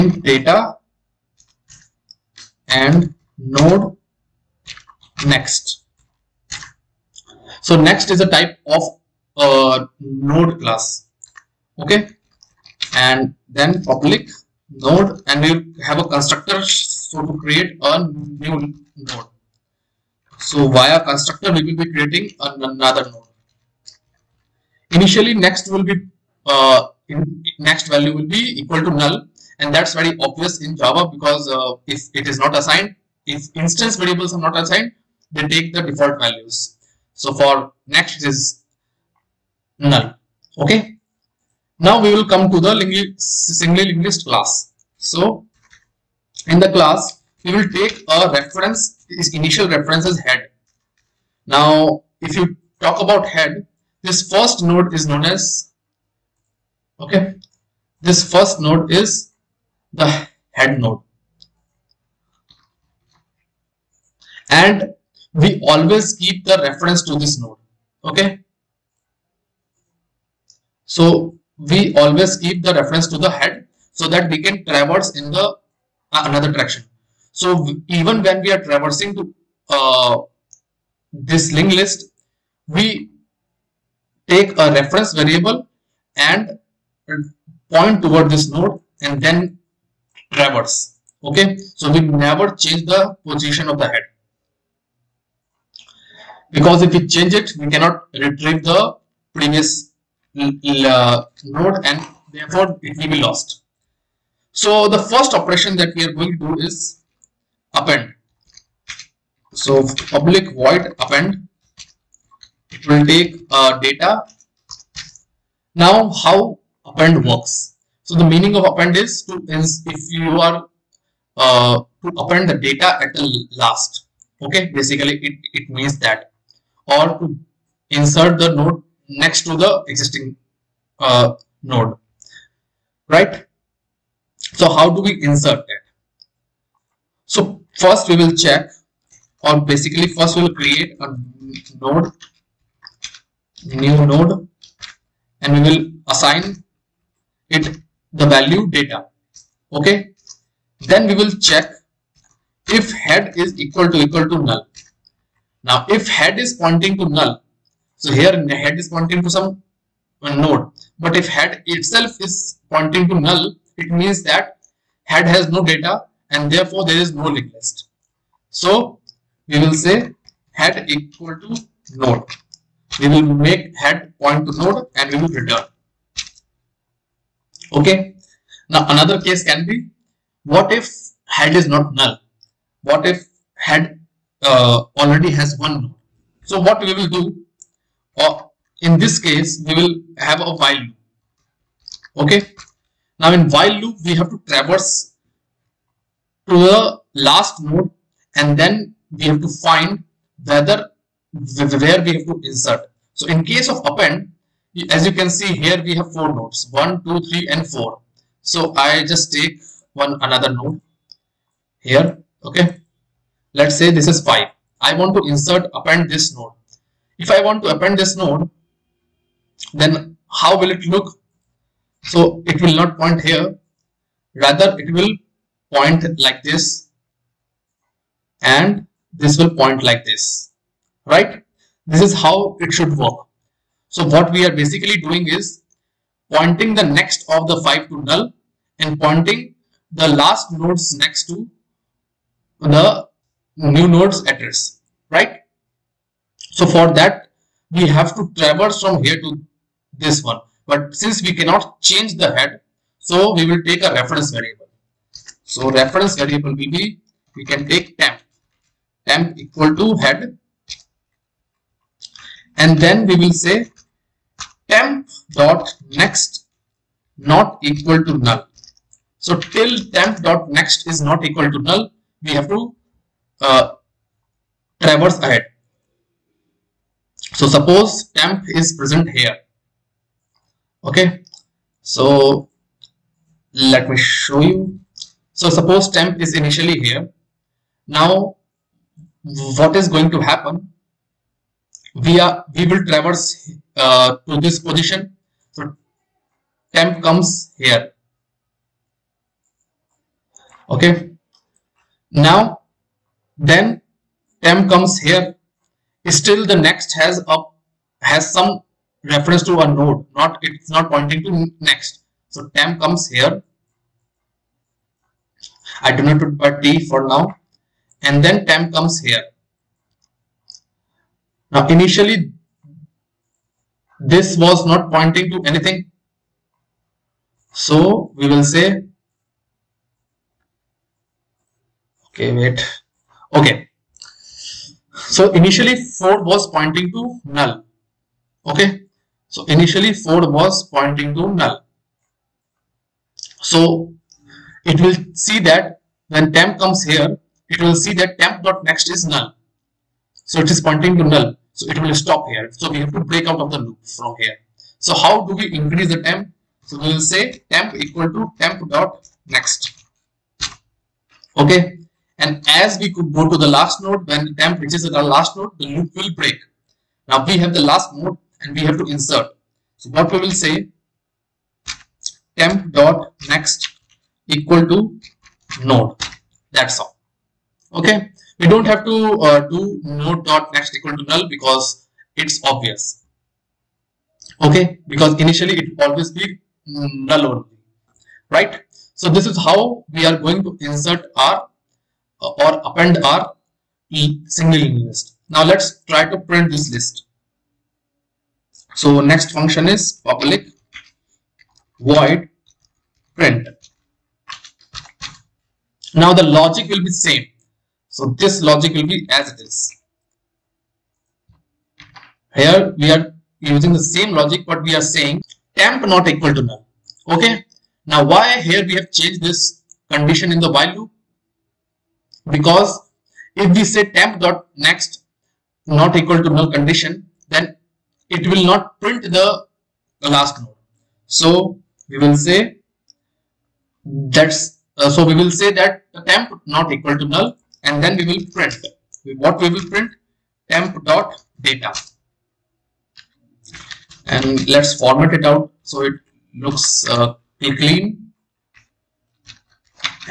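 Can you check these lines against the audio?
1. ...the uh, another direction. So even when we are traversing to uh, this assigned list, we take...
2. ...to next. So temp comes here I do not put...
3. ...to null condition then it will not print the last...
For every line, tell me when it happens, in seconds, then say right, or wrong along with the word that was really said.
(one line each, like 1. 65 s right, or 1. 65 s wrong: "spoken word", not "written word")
1. 75 s wrong: "linked", not "assigned"
2. 311 s right
3. 426 s right.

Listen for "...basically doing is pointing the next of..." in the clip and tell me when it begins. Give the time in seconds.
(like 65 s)
234 s.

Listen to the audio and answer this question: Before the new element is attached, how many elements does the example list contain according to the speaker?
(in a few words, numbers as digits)
4.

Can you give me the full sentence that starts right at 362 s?
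And as we could go to the last node, when temp reaches the last node, the loop will break.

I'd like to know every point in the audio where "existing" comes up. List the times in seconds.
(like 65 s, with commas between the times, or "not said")
129 s.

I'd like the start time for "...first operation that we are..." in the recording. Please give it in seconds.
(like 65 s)
104 s.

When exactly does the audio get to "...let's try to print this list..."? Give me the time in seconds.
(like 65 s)
395 s.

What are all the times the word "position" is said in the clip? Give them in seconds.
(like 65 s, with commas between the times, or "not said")
93 s, 294 s.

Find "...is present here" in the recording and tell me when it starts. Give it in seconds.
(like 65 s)
278 s.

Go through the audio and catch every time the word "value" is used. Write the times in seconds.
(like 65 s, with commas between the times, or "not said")
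27 s, 36 s, 148 s.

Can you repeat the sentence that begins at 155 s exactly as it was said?
Now if head is pointing to null, so here head is pointing to some uh, node.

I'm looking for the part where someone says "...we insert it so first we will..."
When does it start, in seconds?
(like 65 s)
135 s.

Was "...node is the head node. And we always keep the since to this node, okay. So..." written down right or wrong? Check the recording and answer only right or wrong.
wrong.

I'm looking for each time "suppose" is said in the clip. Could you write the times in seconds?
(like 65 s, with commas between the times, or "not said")
277 s, 285 s.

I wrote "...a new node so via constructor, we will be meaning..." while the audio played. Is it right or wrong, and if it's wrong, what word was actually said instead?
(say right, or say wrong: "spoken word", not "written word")
wrong: "creating", not "meaning".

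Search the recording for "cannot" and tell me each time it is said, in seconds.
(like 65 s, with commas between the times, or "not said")
97 s, 251 s.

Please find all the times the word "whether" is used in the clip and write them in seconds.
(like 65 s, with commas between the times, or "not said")
200 s.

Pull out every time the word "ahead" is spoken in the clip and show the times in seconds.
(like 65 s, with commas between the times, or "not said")
275 s.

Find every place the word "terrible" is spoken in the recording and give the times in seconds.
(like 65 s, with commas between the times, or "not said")
not said.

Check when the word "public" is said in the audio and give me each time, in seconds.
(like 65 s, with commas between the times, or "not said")
13 s, 110 s, 400 s.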